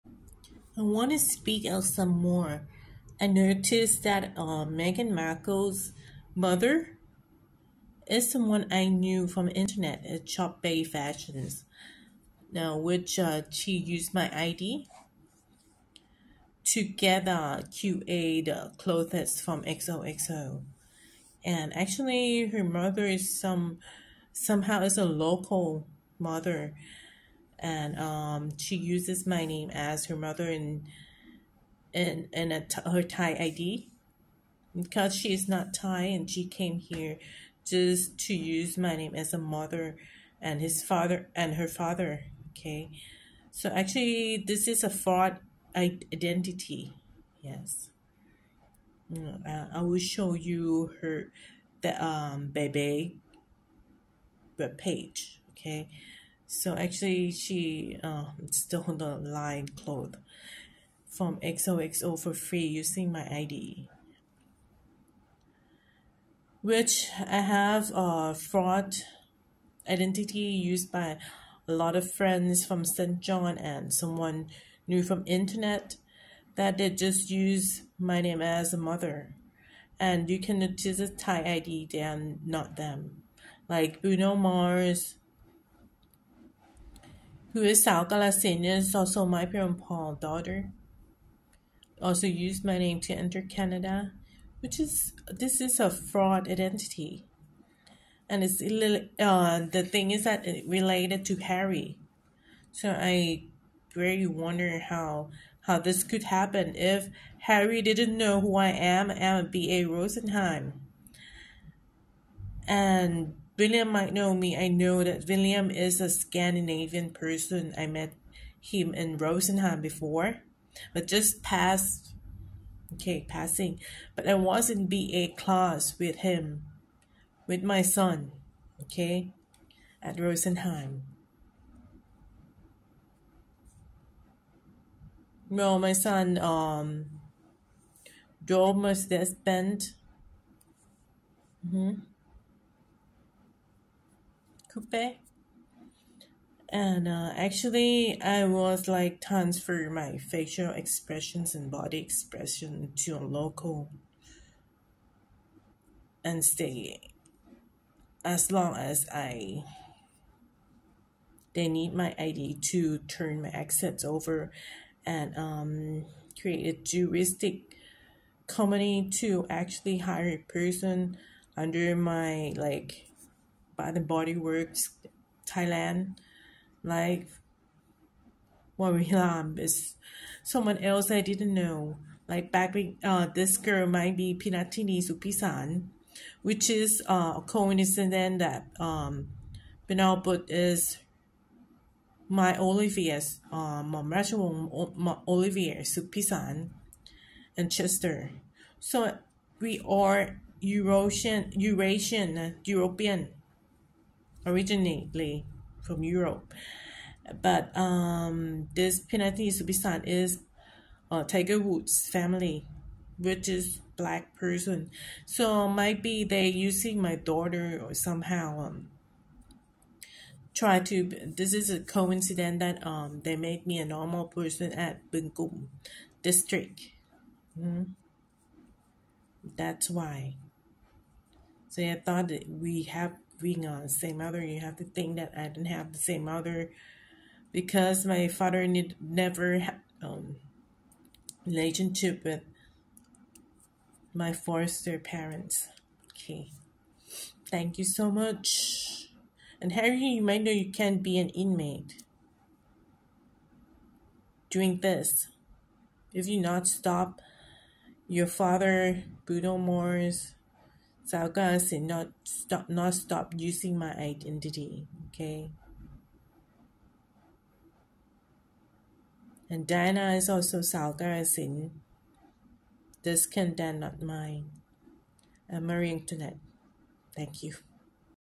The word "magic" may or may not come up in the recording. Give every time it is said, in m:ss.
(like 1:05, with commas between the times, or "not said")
not said.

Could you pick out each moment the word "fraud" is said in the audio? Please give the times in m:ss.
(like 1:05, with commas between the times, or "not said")
0:44, 1:08, 1:35.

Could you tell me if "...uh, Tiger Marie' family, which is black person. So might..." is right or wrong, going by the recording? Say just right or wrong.
wrong.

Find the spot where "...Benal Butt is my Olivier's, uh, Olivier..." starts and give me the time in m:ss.
3:09.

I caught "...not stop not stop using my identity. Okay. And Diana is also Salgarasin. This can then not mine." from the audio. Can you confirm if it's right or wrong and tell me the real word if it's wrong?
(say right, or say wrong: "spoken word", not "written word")
right.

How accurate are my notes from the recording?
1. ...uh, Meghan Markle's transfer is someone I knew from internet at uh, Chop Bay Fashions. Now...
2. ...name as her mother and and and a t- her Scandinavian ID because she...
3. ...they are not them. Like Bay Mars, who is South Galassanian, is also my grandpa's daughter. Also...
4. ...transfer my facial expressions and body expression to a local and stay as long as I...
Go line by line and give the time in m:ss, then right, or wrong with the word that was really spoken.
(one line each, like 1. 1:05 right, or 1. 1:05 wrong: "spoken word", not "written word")
1. 0:04 wrong: "mother", not "transfer"
2. 0:29 wrong: "Thai", not "Scandinavian"
3. 1:21 wrong: "Bruno", not "Bay"
4. 2:29 right.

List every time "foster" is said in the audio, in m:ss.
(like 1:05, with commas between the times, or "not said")
4:04.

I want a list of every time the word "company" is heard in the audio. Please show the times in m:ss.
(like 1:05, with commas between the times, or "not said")
2:48.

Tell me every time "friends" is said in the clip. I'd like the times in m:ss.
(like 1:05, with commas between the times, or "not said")
1:12.